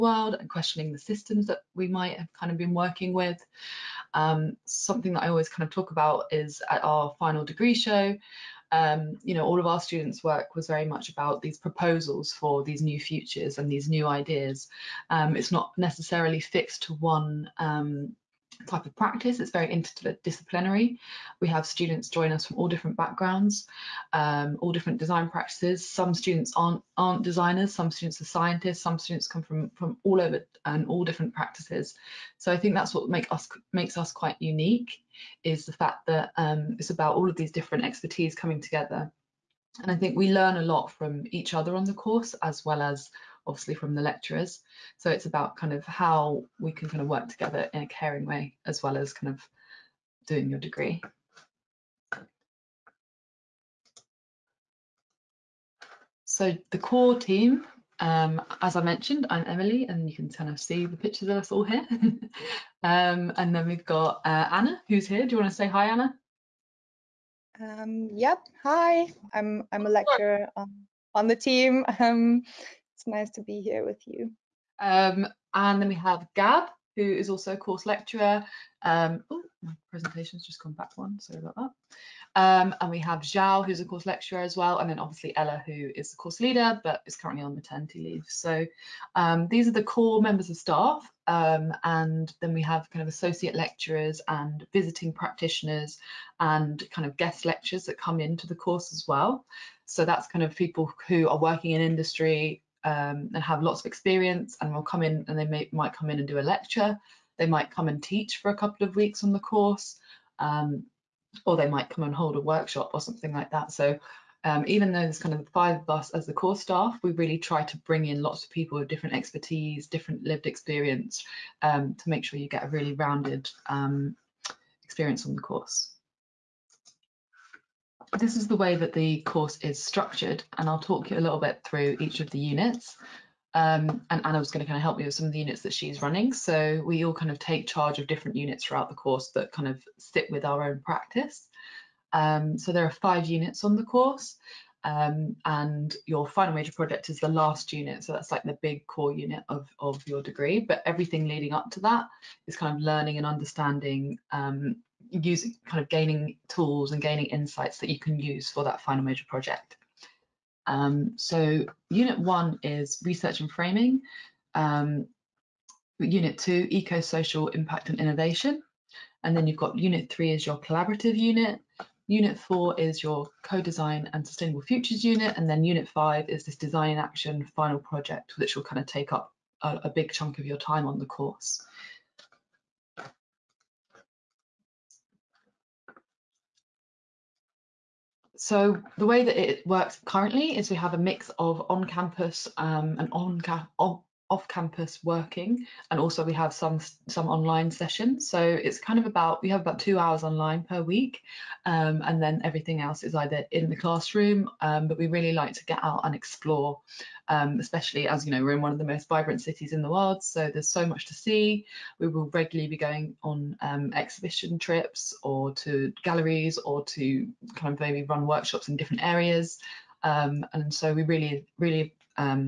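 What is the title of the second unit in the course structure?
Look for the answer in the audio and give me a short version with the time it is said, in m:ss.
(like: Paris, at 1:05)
Eco-social impact and innovation, at 2:46.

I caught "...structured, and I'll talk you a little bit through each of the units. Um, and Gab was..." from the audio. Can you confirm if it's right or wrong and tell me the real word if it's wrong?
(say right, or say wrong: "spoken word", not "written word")
wrong: "Anna", not "Gab".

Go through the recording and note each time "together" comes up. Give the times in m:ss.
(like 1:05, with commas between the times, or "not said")
0:38, 0:47.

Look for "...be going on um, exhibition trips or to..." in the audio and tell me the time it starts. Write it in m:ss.
3:32.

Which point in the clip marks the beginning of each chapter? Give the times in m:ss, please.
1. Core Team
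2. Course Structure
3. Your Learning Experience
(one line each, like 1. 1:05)
1. 0:56
2. 2:09
3. 3:05.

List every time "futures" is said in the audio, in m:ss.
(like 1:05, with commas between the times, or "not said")
0:12, 2:54.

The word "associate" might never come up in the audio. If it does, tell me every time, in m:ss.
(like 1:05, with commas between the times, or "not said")
1:33.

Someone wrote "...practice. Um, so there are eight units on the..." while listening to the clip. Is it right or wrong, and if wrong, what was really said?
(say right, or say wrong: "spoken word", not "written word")
wrong: "five", not "eight".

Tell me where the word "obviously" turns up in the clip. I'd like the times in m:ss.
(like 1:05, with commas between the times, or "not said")
0:43, 1:24.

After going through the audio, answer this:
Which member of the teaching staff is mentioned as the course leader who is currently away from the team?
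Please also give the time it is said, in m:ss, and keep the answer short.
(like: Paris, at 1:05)
Ella, at 1:25.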